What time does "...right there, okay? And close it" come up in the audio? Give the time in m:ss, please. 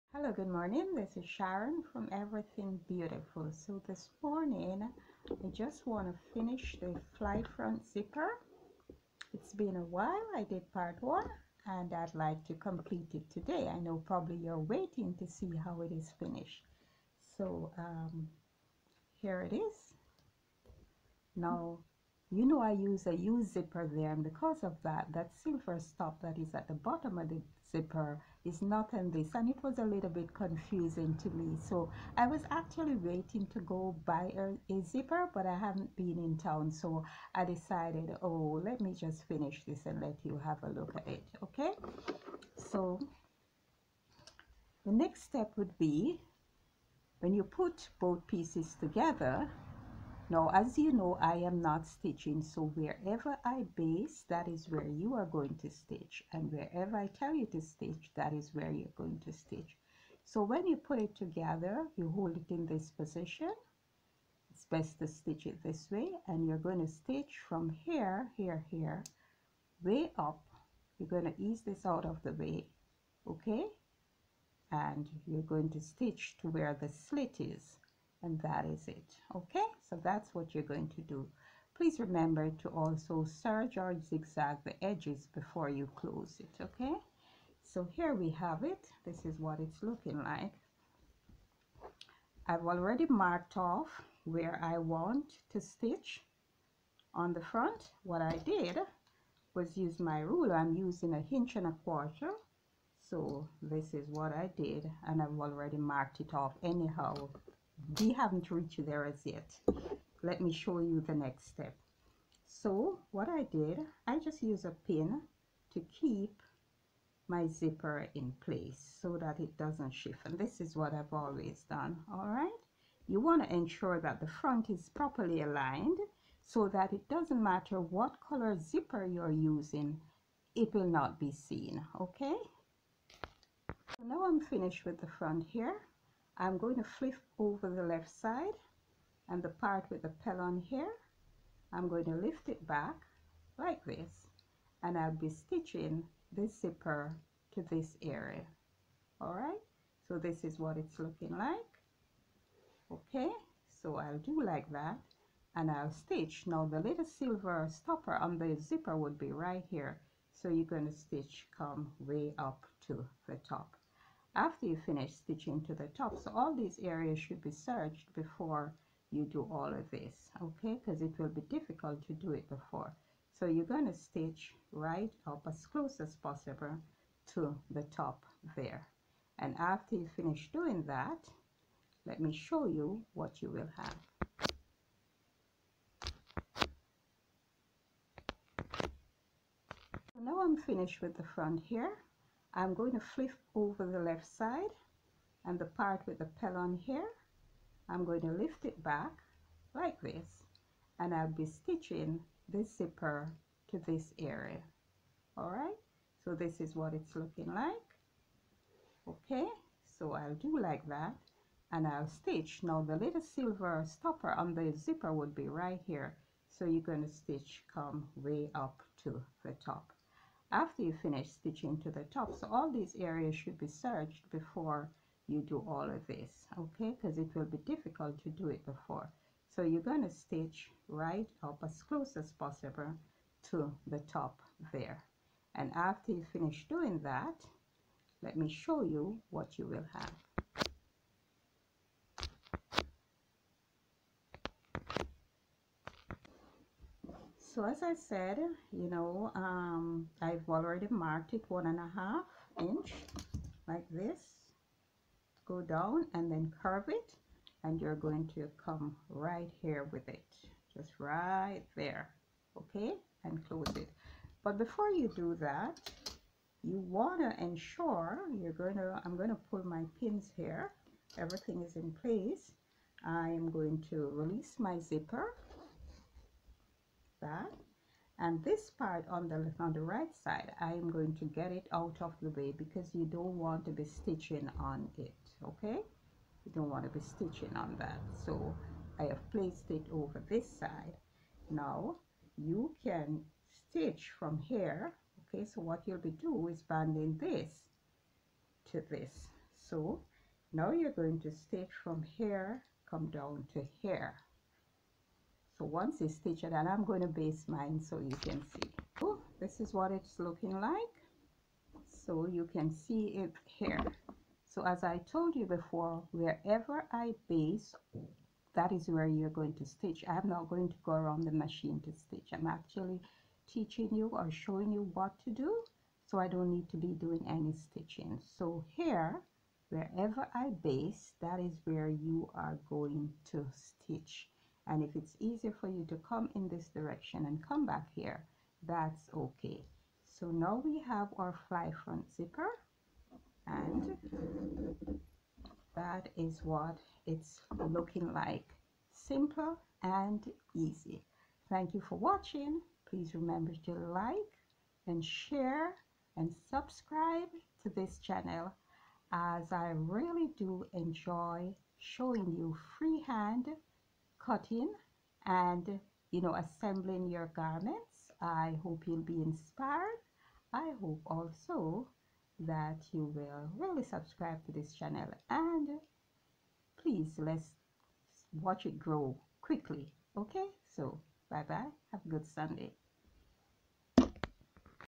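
4:20.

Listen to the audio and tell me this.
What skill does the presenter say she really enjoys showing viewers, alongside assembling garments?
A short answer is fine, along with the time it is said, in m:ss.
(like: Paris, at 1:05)
freehand cutting, at 6:02.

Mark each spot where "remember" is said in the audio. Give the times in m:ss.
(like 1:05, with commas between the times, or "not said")
1:21, 5:53.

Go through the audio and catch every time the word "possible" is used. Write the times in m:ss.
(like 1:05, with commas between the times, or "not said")
2:56, 3:52.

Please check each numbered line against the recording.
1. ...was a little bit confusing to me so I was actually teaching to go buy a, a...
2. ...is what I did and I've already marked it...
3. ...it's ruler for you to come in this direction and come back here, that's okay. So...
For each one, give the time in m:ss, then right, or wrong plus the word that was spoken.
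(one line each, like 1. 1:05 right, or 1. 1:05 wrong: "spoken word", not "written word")
1. 0:29 wrong: "waiting", not "teaching"
2. 1:43 right
3. 5:34 wrong: "easier", not "ruler".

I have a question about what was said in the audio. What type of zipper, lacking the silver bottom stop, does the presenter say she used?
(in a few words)
U zipper.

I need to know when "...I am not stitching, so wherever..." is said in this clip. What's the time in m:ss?
0:51.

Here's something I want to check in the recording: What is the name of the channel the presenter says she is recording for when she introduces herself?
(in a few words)
Everything Beautiful.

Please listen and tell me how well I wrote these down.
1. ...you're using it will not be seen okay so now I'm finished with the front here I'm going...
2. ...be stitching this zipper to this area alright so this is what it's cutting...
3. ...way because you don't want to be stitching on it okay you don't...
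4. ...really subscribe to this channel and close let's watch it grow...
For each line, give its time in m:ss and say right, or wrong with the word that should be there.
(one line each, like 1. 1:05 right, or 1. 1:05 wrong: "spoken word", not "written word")
1. 2:09 right
2. 3:21 wrong: "looking", not "cutting"
3. 4:42 right
4. 6:13 wrong: "please", not "close".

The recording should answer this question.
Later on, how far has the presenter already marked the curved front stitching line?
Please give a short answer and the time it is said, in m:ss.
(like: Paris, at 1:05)
1 and a half inch, at 4:11.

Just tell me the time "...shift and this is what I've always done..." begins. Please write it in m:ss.
1:59.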